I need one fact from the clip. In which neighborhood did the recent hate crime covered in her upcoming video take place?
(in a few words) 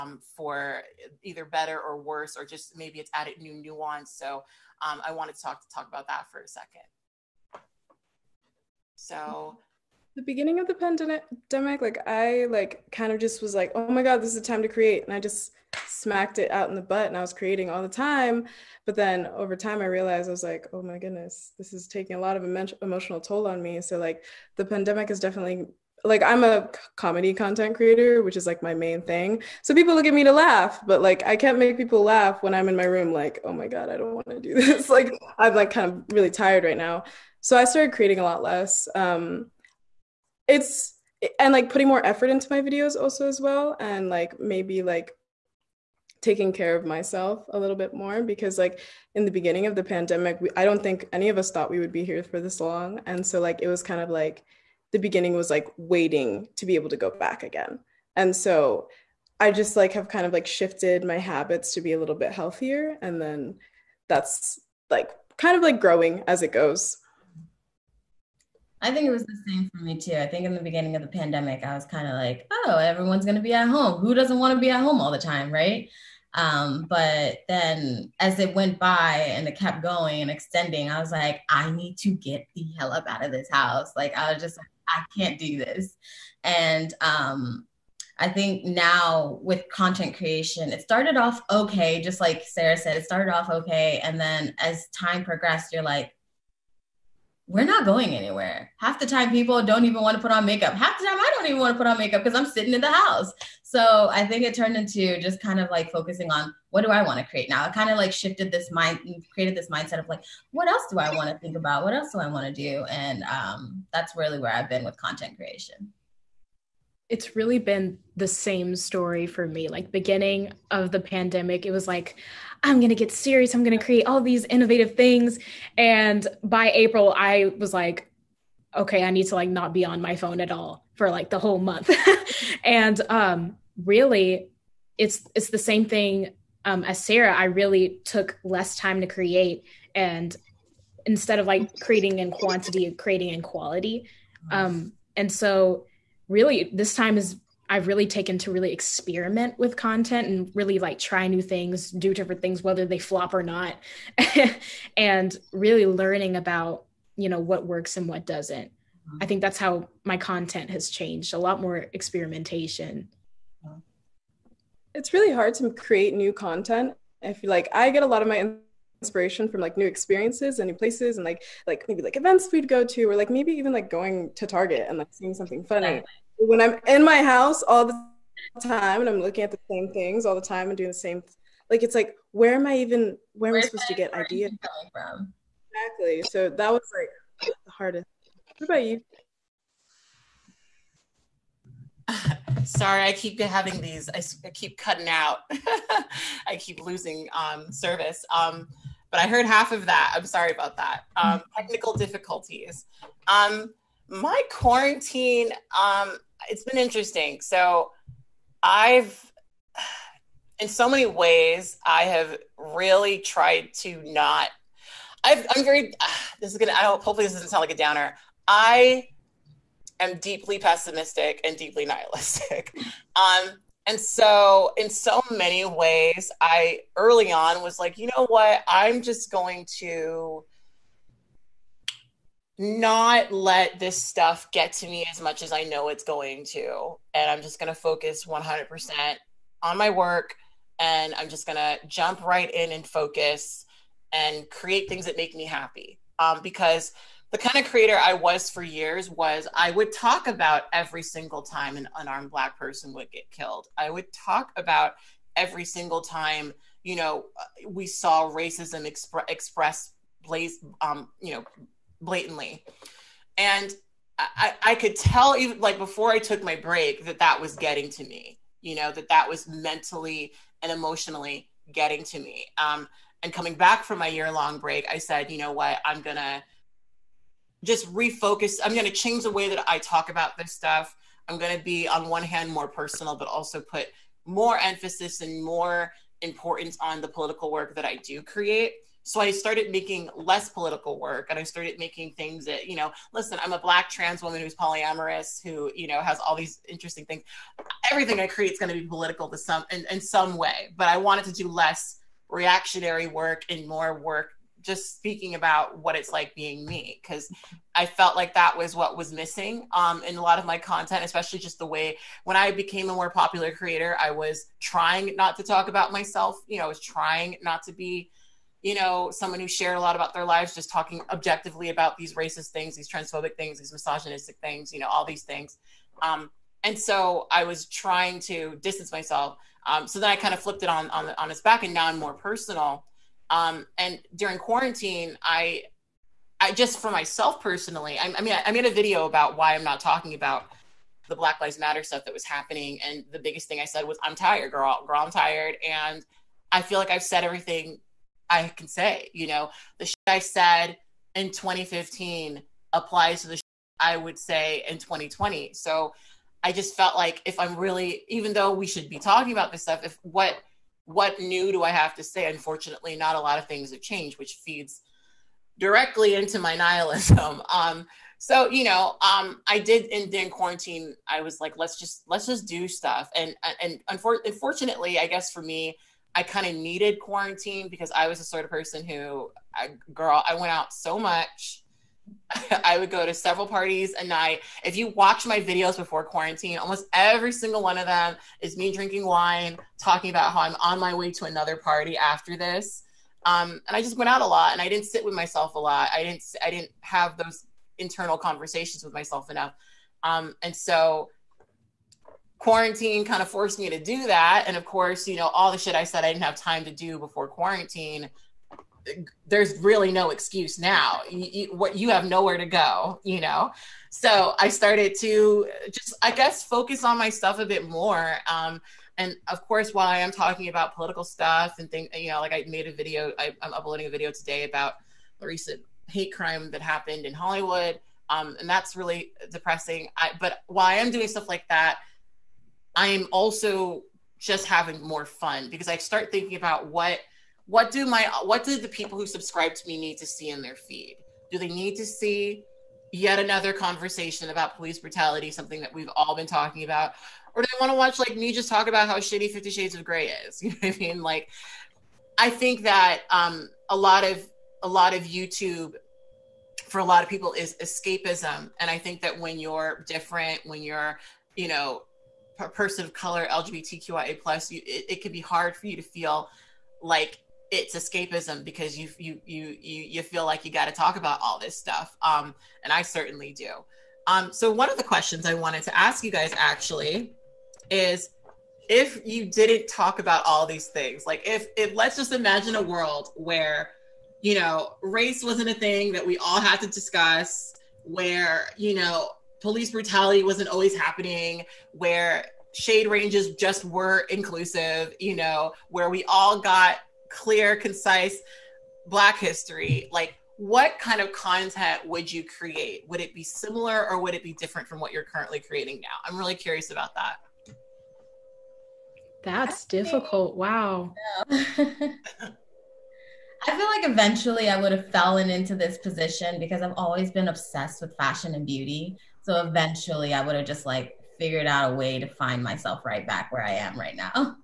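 Hollywood.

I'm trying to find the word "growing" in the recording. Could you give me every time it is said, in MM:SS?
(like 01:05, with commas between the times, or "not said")
01:05.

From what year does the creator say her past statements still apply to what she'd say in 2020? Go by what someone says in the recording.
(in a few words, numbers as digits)
2015.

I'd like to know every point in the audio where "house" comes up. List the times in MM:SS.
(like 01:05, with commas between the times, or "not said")
01:23, 01:42, 02:57.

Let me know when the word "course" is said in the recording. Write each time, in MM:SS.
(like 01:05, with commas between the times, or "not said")
06:44, 06:59.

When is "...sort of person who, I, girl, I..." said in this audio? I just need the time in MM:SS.
06:18.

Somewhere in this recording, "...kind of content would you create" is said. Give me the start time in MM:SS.
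08:20.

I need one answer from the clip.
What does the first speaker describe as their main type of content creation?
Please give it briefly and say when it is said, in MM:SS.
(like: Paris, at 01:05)
comedy, at 00:26.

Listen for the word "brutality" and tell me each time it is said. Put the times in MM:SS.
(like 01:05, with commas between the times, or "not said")
07:24, 08:09.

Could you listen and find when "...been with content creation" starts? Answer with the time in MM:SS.
01:54.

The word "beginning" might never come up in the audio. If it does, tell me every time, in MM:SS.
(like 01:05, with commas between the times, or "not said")
00:10, 00:49, 00:54, 01:10, 01:59.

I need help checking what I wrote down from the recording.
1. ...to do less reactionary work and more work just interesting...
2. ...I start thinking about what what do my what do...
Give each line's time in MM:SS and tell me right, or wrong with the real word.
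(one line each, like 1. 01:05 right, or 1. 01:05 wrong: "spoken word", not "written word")
1. 05:01 wrong: "speaking", not "interesting"
2. 07:15 right.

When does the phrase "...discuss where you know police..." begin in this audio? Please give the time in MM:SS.
08:06.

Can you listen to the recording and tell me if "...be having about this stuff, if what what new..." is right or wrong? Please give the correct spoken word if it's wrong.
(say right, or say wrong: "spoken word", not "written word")
wrong: "talking", not "having".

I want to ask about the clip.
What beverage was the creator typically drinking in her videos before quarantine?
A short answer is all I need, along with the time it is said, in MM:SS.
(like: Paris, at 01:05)
wine, at 06:29.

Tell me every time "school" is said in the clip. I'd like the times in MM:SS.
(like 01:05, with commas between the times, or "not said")
not said.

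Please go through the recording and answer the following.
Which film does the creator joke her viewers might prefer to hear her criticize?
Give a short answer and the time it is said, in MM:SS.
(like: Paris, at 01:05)
Fifty Shades of Grey, at 07:29.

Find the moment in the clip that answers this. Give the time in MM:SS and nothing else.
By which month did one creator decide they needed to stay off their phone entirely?
02:06.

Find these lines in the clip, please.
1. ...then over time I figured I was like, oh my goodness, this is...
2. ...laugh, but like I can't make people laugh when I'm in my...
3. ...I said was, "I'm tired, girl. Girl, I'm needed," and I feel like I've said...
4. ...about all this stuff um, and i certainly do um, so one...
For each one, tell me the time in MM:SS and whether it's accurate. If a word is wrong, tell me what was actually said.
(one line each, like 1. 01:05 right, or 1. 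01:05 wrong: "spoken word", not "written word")
1. 00:18 wrong: "realized", not "figured"
2. 00:30 right
3. 05:43 wrong: "tired", not "needed"
4. 07:50 right.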